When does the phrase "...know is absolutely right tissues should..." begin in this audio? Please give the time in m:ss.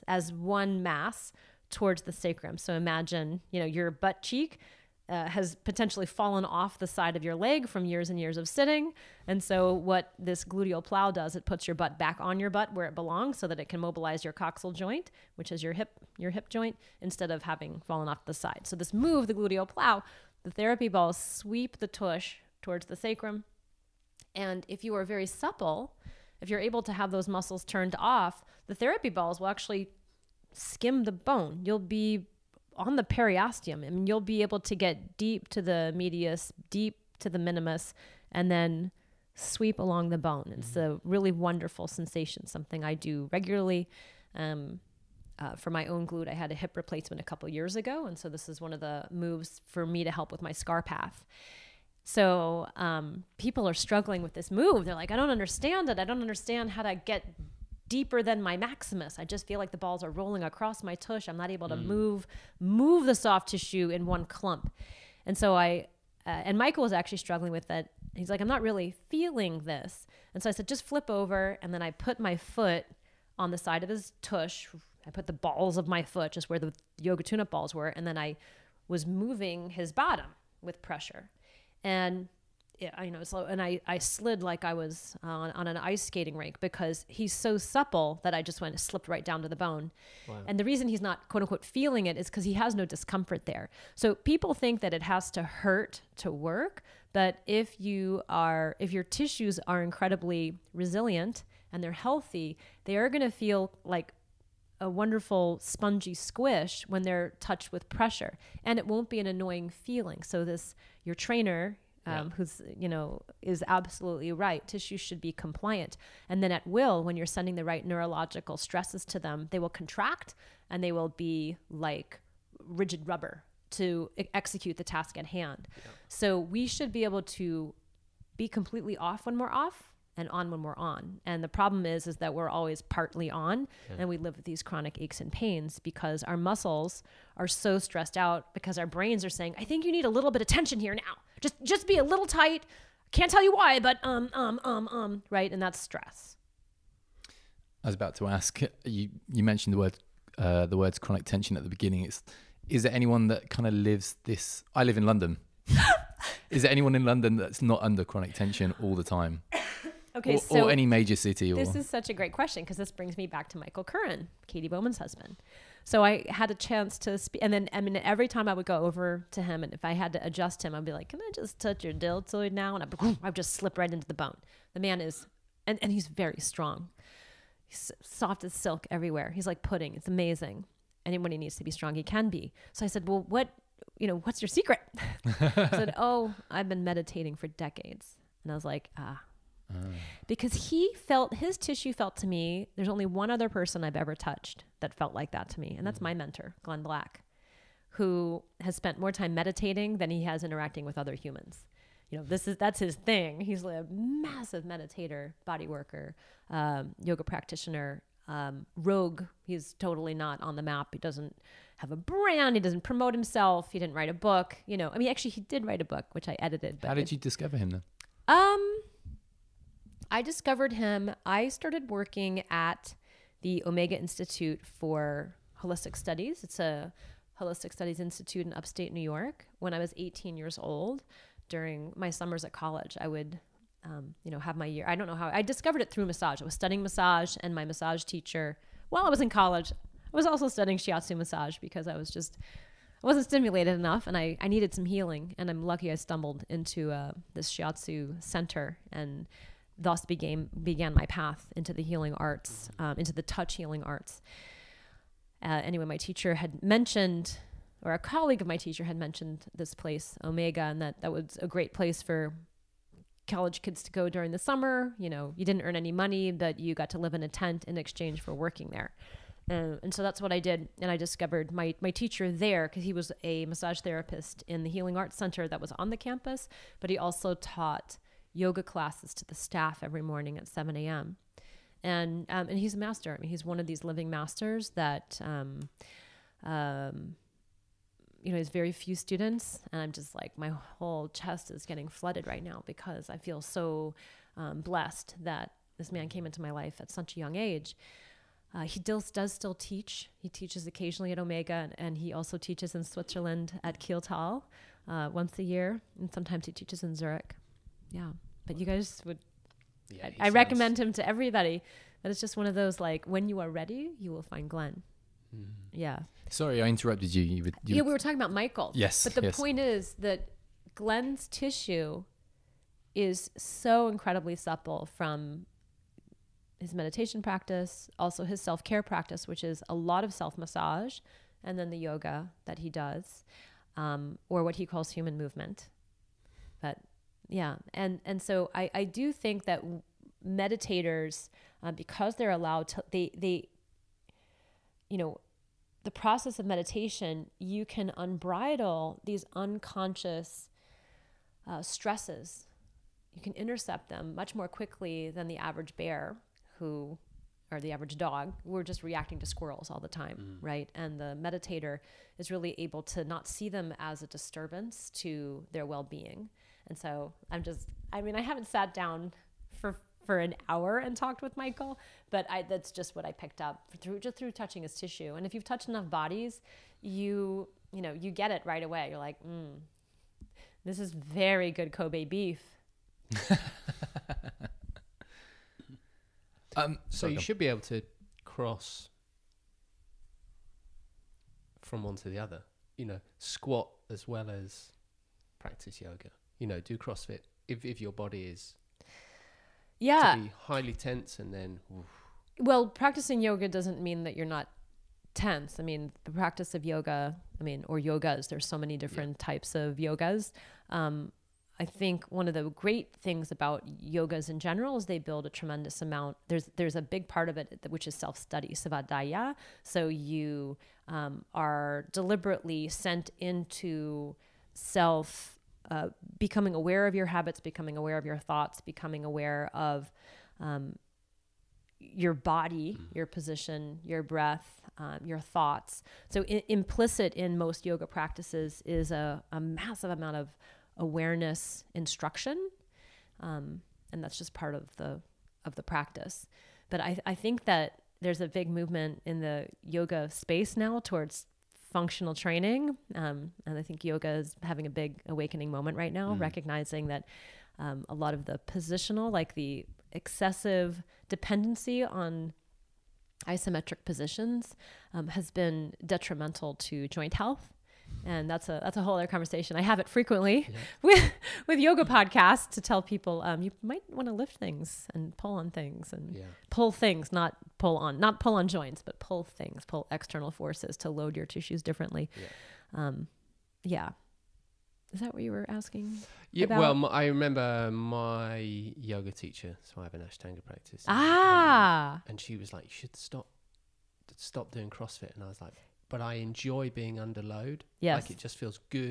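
1:52.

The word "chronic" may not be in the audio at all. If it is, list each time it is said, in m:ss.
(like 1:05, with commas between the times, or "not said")
2:14, 2:30, 2:38.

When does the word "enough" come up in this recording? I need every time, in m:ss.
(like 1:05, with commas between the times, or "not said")
4:03, 6:15.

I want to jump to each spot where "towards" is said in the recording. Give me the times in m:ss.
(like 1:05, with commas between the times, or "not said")
0:01, 0:22, 7:30.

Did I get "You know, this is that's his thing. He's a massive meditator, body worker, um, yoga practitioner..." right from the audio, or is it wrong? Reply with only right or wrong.
right.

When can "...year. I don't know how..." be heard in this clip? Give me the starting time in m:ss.
3:54.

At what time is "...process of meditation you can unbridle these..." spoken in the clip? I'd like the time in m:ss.
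5:45.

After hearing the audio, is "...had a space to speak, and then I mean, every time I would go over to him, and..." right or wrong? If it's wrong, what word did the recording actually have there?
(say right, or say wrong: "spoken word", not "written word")
wrong: "chance", not "space".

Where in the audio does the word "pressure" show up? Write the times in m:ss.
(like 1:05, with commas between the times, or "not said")
1:20, 1:47.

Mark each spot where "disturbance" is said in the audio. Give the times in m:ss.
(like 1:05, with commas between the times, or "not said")
6:04.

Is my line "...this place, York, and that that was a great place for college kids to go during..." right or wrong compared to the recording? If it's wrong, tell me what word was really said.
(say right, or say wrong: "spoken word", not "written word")
wrong: "Omega", not "York".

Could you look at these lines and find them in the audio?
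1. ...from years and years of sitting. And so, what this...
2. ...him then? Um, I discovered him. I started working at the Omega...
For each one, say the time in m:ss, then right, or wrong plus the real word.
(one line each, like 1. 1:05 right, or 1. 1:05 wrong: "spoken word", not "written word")
1. 0:07 right
2. 3:37 right.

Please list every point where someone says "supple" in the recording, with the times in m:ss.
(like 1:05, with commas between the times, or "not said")
0:25, 1:27, 5:24.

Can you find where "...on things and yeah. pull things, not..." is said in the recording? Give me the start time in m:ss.
7:55.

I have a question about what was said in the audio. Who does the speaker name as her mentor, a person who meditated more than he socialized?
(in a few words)
Glenn Black.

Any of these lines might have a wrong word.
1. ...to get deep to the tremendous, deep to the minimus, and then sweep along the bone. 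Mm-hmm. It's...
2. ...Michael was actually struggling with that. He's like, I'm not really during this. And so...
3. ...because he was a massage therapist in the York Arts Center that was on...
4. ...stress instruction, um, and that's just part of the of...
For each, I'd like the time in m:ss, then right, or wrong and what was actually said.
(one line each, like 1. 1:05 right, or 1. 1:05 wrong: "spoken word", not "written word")
1. 0:34 wrong: "medius", not "tremendous"
2. 1:06 wrong: "feeling", not "during"
3. 4:32 wrong: "Healing", not "York"
4. 7:20 wrong: "awareness", not "stress".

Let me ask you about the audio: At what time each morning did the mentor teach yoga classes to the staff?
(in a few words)
7 a.m.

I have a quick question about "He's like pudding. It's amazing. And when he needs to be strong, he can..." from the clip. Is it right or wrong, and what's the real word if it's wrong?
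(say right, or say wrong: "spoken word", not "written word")
right.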